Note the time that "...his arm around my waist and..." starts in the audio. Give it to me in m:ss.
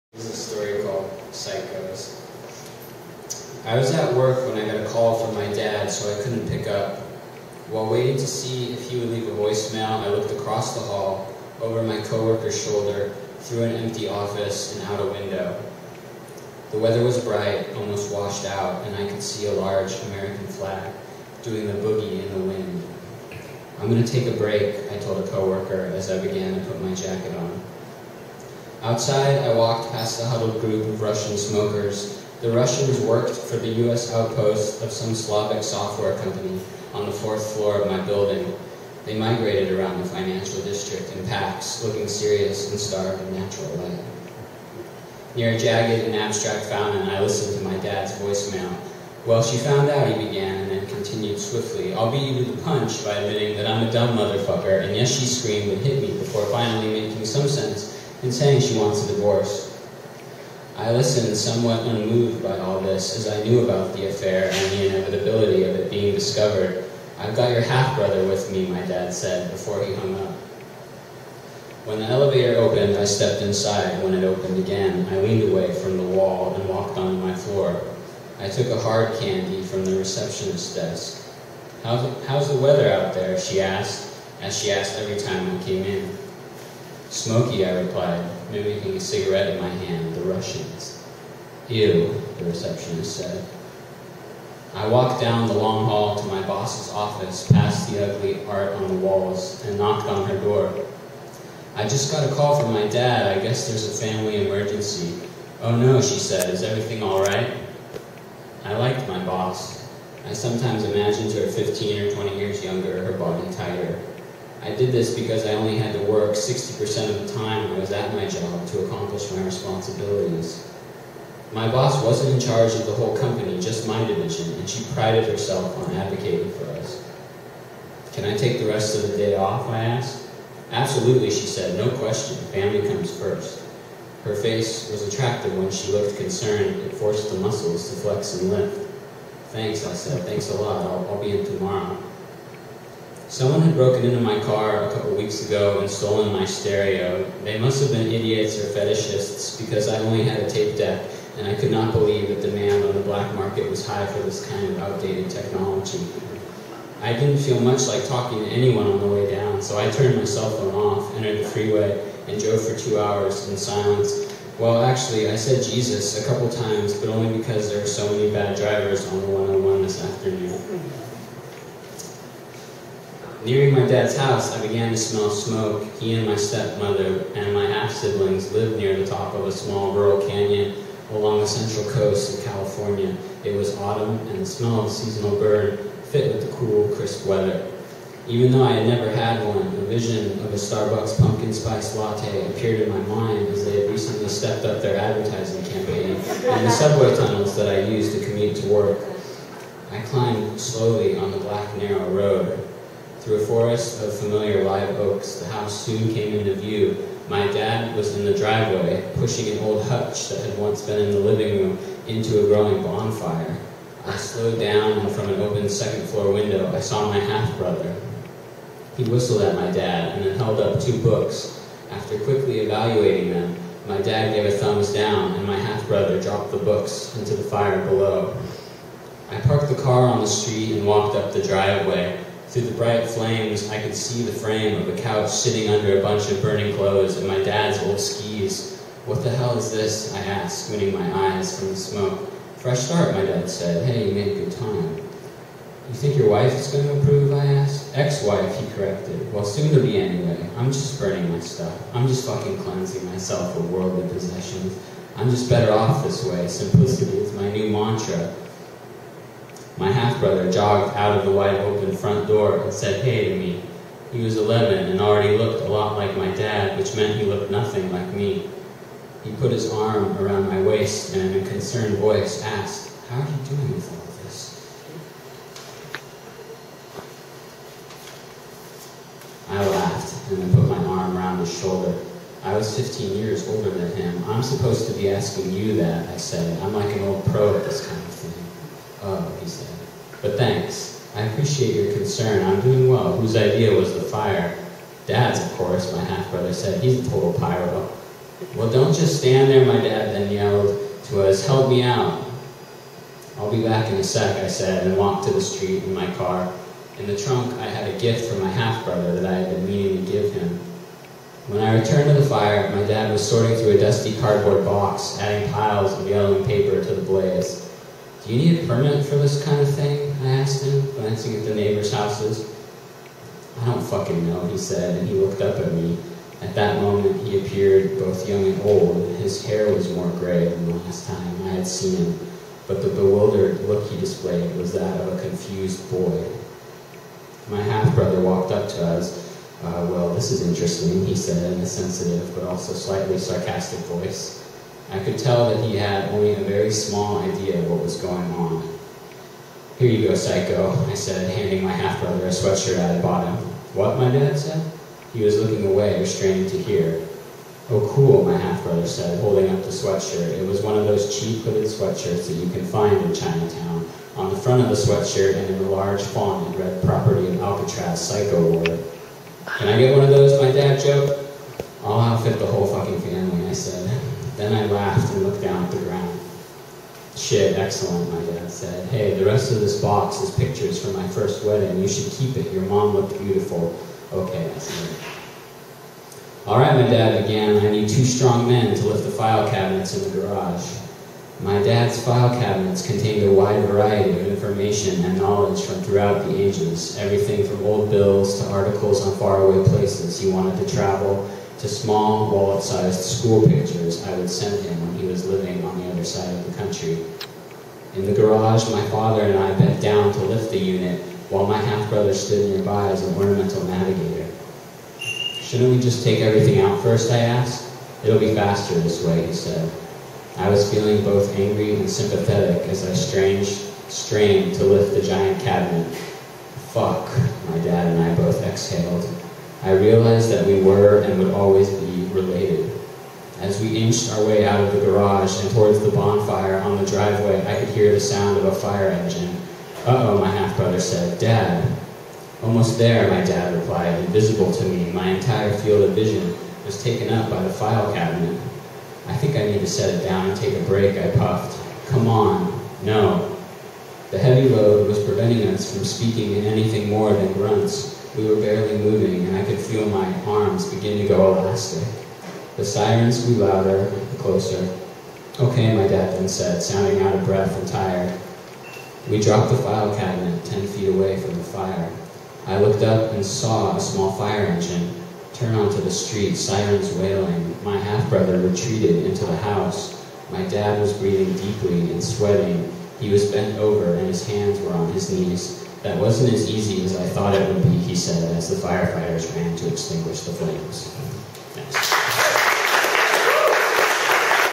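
4:29.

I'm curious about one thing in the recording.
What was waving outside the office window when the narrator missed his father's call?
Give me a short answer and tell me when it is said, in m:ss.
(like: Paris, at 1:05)
American flag, at 0:20.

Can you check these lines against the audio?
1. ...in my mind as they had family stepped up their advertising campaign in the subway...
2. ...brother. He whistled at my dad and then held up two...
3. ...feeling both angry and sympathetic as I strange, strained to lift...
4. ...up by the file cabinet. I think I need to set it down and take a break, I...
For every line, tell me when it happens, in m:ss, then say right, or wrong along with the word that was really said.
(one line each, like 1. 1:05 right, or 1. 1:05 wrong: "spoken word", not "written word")
1. 3:12 wrong: "recently", not "family"
2. 3:37 right
3. 7:00 right
4. 7:27 right.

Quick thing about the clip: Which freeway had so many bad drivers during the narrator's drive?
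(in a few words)
The 101.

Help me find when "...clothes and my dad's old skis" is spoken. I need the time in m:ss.
3:56.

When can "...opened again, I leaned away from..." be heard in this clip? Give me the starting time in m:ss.
1:14.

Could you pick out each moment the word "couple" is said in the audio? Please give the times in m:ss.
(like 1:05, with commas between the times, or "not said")
2:24, 2:46.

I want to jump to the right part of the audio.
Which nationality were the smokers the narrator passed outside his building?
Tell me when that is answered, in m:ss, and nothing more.
0:31.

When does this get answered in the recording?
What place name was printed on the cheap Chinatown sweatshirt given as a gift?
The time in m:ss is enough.
6:07.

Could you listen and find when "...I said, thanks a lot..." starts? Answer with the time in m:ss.
2:19.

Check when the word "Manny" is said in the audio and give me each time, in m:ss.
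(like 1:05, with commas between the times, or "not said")
not said.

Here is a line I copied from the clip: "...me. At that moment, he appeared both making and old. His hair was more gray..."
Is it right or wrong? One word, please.
wrong.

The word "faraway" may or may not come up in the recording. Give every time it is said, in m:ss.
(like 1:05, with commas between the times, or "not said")
6:39.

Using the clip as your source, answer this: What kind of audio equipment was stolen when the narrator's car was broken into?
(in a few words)
Tape deck.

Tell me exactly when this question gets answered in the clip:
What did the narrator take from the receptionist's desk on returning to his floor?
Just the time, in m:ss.
1:18.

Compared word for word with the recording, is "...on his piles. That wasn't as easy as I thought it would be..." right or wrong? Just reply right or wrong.
wrong.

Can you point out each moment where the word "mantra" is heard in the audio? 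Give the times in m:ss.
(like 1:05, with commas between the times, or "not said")
4:17.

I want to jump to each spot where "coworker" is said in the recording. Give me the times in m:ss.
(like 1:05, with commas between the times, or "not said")
0:12, 0:25.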